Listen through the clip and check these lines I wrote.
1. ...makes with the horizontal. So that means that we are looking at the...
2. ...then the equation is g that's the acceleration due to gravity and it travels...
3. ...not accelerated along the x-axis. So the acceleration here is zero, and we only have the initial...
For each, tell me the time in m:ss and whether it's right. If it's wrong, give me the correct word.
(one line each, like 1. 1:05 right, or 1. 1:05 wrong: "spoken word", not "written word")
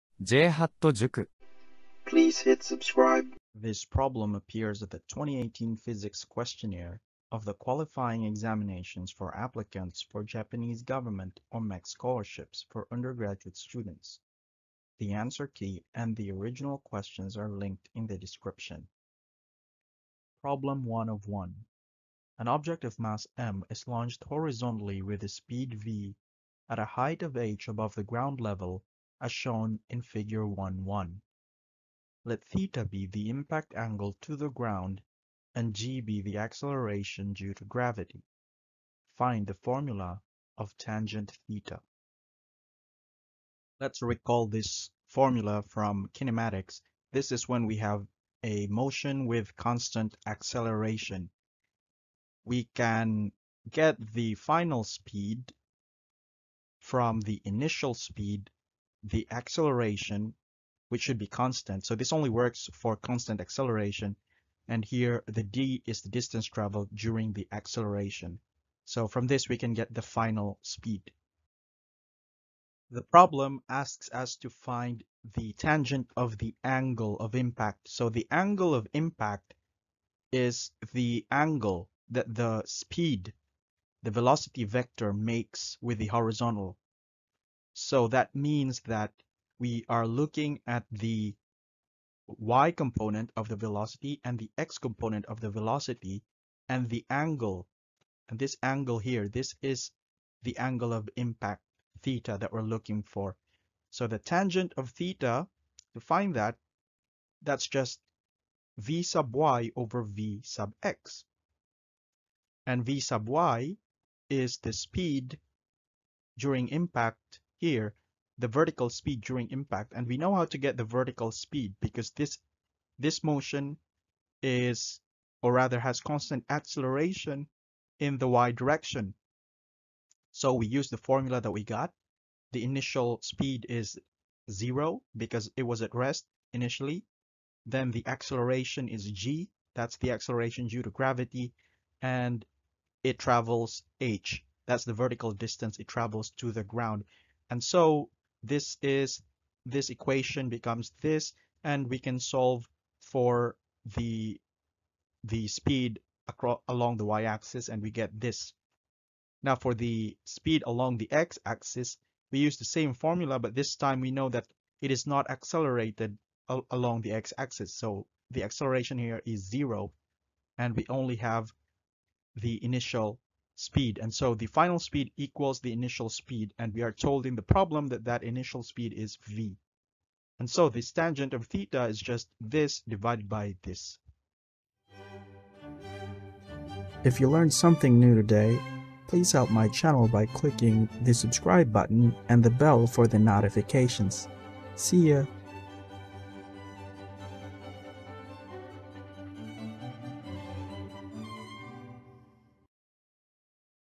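1. 1:25 right
2. 2:17 wrong: "acceleration", not "equation"
3. 2:45 right.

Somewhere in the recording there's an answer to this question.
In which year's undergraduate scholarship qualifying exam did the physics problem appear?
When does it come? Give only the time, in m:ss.
0:05.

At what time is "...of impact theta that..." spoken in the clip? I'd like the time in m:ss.
1:40.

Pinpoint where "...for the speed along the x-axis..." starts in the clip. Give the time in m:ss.
2:39.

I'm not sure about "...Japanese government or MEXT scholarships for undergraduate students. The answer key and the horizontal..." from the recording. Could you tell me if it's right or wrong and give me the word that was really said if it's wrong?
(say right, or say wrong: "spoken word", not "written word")
wrong: "original", not "horizontal".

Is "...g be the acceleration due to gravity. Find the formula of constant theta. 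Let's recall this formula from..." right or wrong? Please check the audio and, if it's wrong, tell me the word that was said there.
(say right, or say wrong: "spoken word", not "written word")
wrong: "tangent", not "constant".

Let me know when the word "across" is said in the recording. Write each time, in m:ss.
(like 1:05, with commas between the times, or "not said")
2:36.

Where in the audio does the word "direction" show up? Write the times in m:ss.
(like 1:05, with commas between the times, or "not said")
2:08.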